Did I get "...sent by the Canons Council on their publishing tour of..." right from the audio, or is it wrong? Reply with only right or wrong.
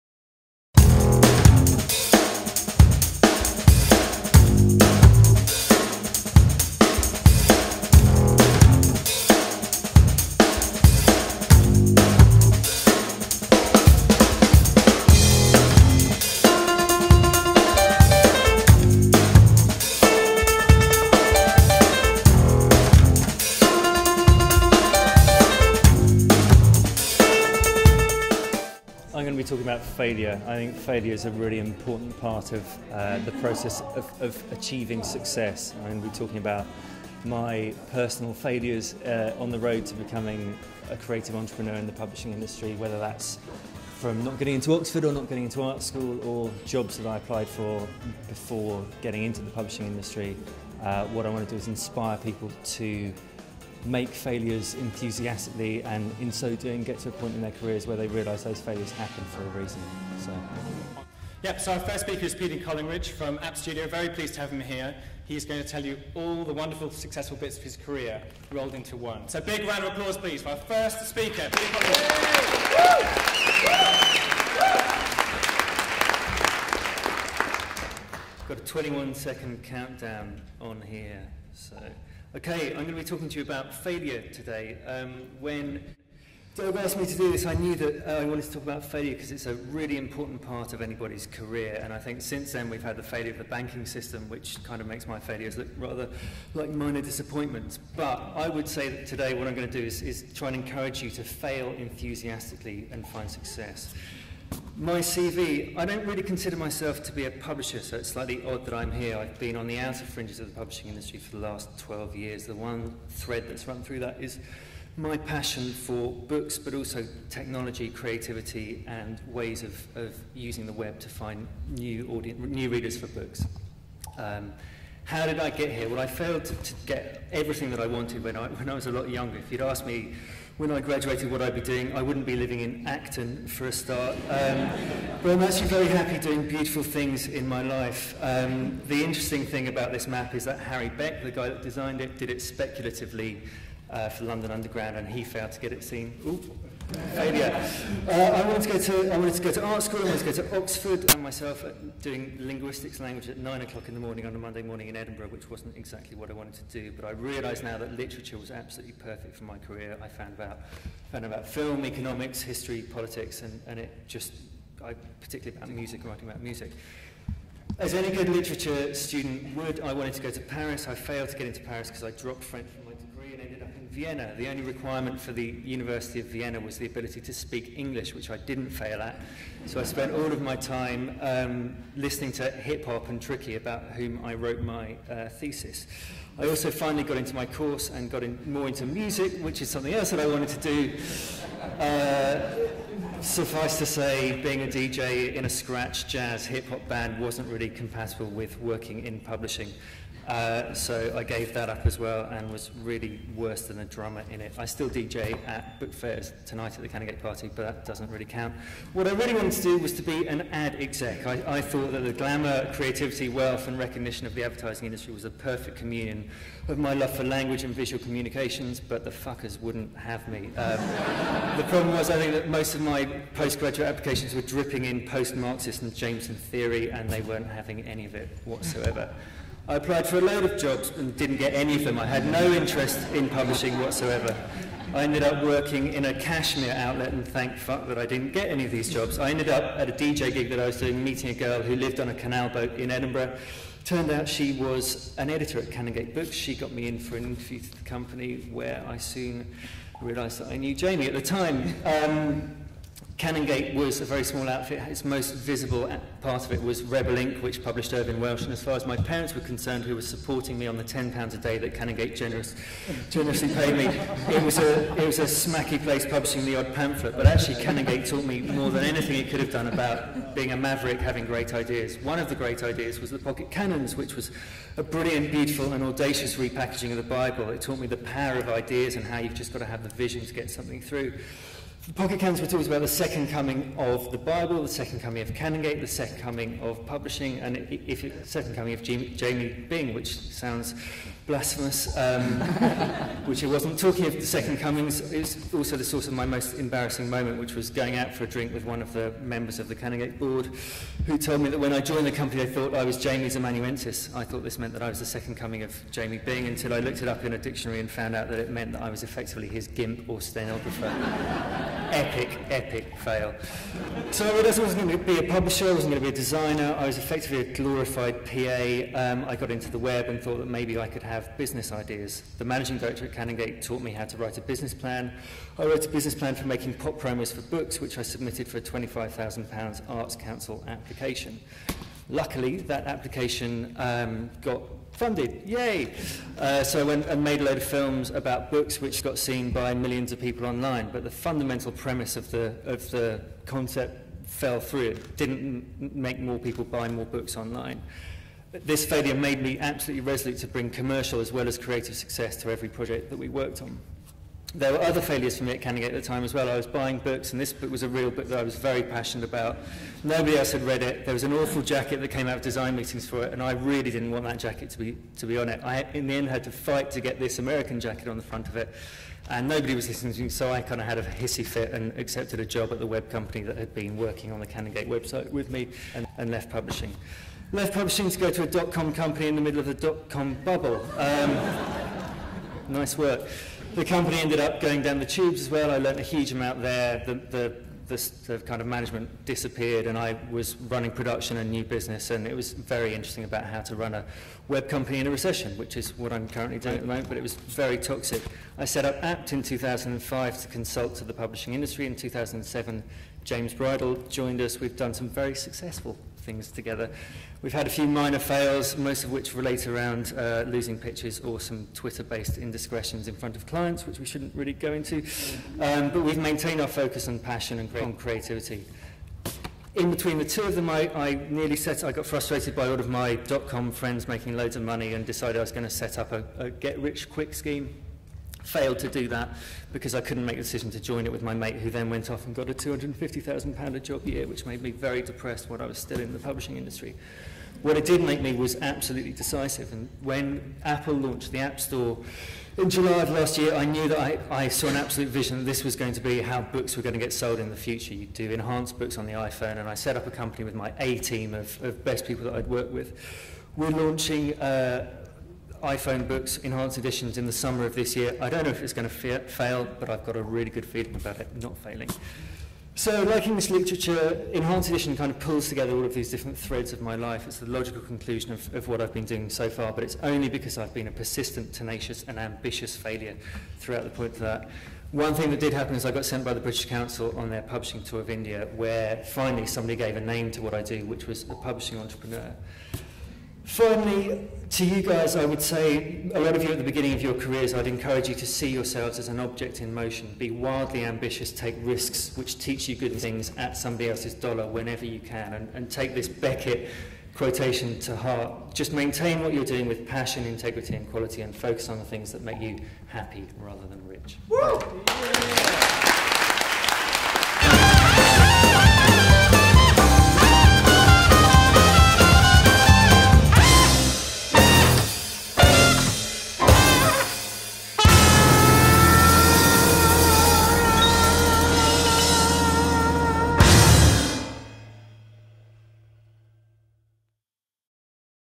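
wrong.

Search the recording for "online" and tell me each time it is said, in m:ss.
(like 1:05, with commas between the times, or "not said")
5:40, 5:47.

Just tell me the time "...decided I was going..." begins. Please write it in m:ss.
7:05.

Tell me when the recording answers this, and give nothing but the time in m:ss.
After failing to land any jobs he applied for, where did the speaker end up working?
3:56.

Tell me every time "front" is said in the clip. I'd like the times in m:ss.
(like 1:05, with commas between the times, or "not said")
6:08, 6:53.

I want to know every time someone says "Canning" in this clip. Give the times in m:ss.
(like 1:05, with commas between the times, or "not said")
5:55.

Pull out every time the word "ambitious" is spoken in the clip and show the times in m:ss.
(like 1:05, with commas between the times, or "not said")
7:52, 8:10.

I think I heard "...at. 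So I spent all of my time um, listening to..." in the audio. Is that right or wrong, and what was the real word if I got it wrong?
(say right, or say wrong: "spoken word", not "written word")
right.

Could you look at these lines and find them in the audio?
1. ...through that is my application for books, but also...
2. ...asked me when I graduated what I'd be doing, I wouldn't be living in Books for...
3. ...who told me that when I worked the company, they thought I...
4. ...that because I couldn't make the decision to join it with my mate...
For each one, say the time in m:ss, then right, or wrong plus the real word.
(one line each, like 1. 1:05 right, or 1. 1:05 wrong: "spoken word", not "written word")
1. 1:53 wrong: "passion", not "application"
2. 2:09 wrong: "Acton", not "Books"
3. 5:01 wrong: "joined", not "worked"
4. 7:09 right.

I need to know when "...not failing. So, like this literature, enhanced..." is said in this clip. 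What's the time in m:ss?
7:41.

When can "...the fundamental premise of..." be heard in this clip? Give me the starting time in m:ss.
5:41.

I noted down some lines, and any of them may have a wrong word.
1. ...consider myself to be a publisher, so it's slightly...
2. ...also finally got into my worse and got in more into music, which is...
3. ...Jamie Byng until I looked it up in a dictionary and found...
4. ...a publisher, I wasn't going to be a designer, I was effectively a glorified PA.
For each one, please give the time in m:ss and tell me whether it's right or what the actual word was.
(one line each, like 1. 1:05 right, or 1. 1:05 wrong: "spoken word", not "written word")
1. 1:46 right
2. 3:06 wrong: "course", not "worse"
3. 5:05 right
4. 5:15 right.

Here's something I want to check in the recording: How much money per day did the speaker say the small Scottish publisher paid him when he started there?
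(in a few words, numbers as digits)
£10.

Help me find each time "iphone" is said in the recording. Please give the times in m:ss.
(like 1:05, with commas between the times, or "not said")
7:29, 7:35.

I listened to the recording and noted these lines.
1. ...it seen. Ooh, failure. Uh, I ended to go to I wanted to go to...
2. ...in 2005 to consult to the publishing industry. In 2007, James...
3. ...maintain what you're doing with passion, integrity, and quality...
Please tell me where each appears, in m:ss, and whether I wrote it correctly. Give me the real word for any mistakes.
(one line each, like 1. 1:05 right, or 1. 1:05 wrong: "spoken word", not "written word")
1. 2:25 wrong: "wanted", not "ended"
2. 6:39 right
3. 8:18 right.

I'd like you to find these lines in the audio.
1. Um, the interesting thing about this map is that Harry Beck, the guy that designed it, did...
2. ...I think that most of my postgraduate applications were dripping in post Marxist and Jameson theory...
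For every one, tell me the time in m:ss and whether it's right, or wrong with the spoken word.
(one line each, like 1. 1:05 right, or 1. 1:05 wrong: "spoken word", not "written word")
1. 2:18 right
2. 3:42 right.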